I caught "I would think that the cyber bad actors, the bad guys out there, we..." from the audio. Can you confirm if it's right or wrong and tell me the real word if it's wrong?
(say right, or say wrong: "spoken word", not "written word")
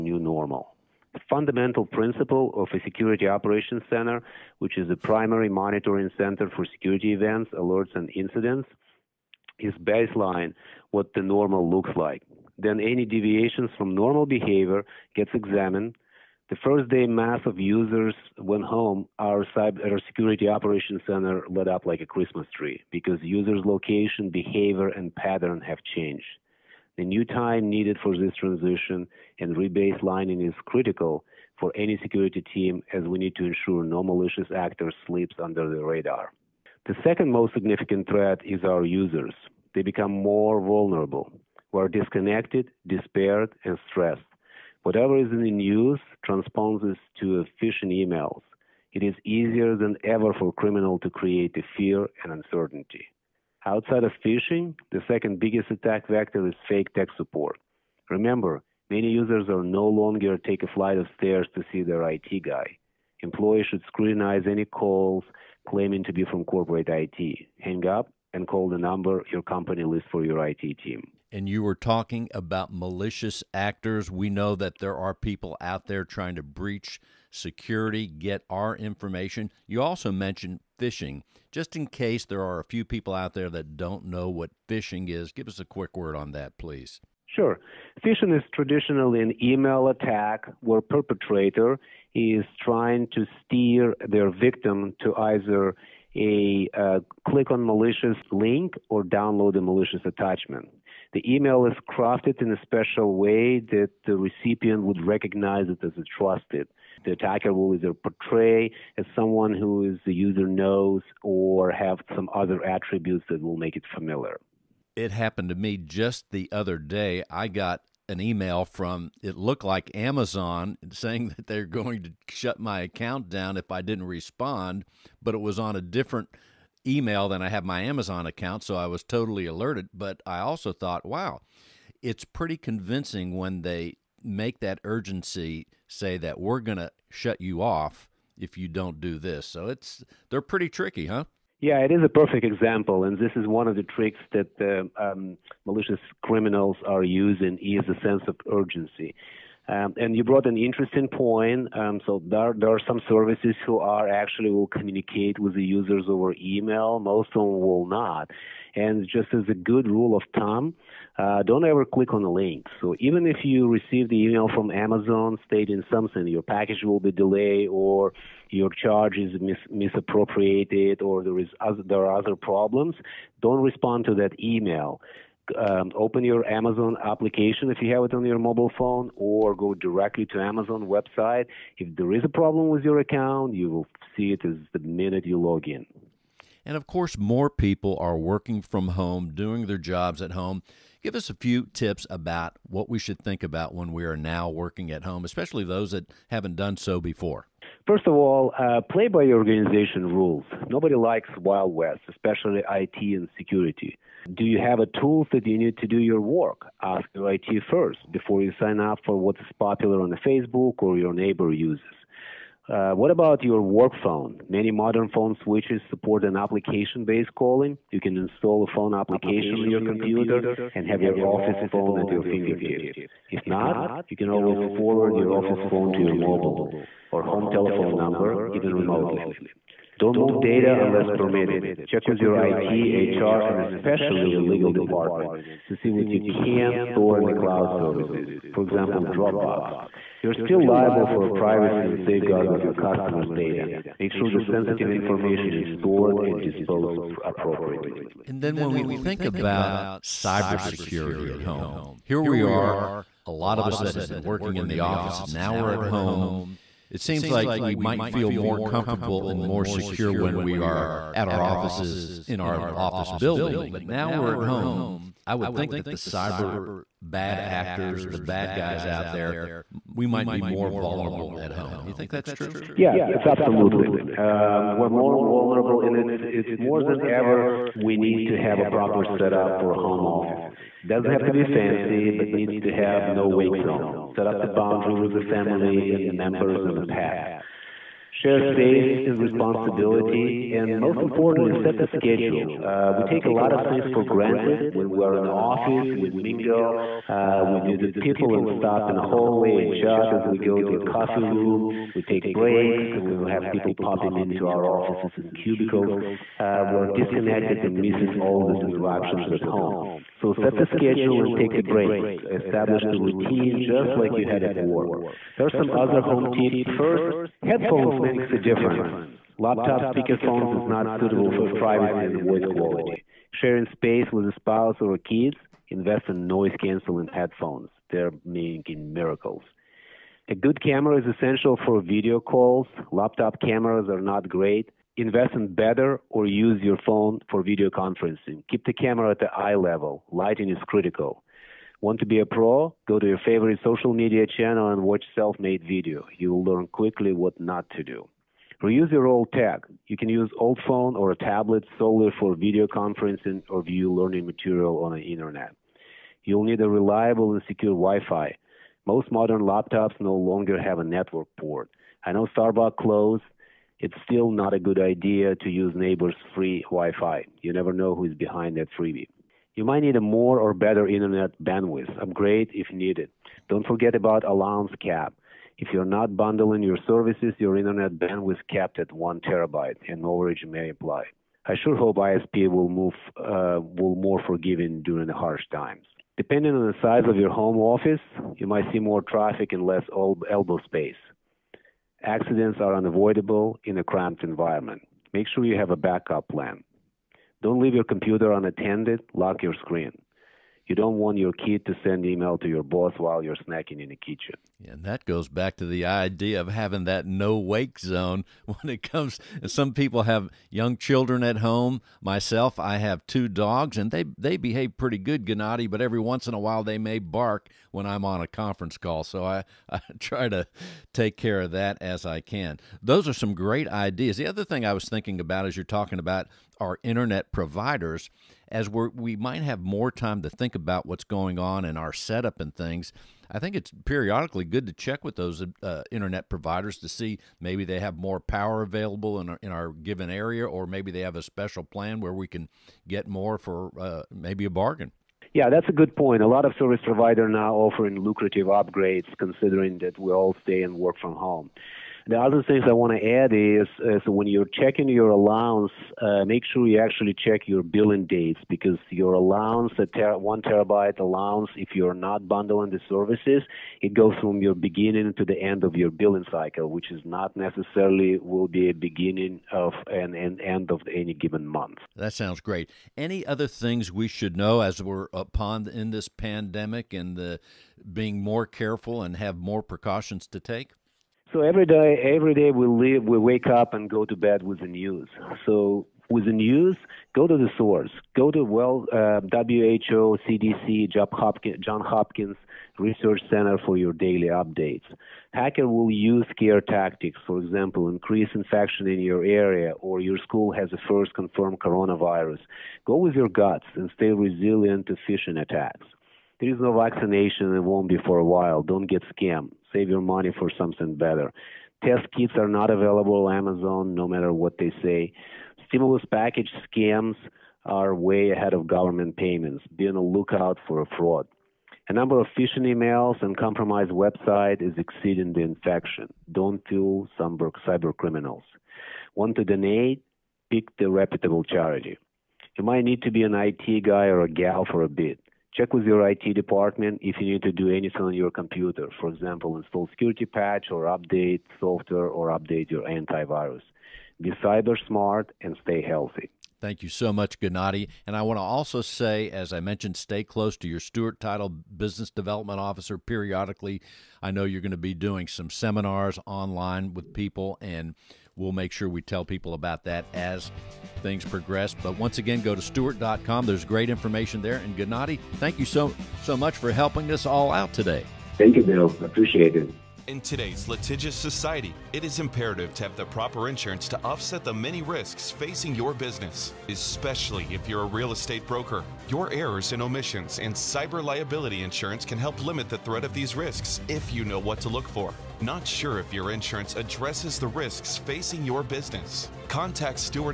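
right.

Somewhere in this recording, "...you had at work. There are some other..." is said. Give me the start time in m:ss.
5:14.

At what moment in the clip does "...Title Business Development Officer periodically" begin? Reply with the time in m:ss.
9:11.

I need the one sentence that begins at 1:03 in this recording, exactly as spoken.
Employees should scrutinize any calls claiming to be from corporate IT.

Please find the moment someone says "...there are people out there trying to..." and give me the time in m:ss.
1:14.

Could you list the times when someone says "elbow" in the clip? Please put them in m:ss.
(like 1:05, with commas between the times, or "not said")
6:30.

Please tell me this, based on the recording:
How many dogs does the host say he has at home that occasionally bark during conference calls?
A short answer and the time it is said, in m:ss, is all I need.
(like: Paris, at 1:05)
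2, at 6:53.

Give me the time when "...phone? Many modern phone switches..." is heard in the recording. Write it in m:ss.
3:34.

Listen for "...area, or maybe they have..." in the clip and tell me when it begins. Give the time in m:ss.
7:20.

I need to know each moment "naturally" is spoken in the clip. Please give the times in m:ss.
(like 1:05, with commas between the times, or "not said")
not said.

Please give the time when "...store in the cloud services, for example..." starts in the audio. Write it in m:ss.
3:56.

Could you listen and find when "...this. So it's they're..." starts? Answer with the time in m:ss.
2:19.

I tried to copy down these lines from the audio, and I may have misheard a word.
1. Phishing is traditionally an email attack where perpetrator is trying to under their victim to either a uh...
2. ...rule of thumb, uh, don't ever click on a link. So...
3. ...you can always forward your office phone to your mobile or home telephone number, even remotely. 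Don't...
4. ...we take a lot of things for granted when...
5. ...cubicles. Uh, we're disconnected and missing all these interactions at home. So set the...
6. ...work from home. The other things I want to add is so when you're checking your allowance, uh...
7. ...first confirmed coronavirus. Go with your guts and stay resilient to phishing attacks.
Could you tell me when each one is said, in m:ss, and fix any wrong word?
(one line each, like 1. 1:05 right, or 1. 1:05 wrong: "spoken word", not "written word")
1. 1:28 wrong: "steer", not "under"
2. 2:39 right
3. 3:44 right
4. 4:52 right
5. 5:05 right
6. 7:30 right
7. 8:20 right.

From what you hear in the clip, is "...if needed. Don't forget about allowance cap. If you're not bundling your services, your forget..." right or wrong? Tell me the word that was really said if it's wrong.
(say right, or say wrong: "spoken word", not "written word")
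wrong: "internet", not "forget".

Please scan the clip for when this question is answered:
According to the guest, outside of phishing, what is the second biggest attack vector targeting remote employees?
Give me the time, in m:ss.
0:56.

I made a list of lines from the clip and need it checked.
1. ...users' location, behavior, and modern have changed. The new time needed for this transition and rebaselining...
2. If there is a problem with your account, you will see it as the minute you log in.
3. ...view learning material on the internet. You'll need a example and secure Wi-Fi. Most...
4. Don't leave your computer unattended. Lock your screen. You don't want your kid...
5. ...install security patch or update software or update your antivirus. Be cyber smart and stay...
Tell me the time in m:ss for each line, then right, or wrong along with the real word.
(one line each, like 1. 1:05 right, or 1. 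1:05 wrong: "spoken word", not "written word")
1. 0:23 wrong: "pattern", not "modern"
2. 3:01 right
3. 5:53 wrong: "reliable", not "example"
4. 6:37 right
5. 8:59 right.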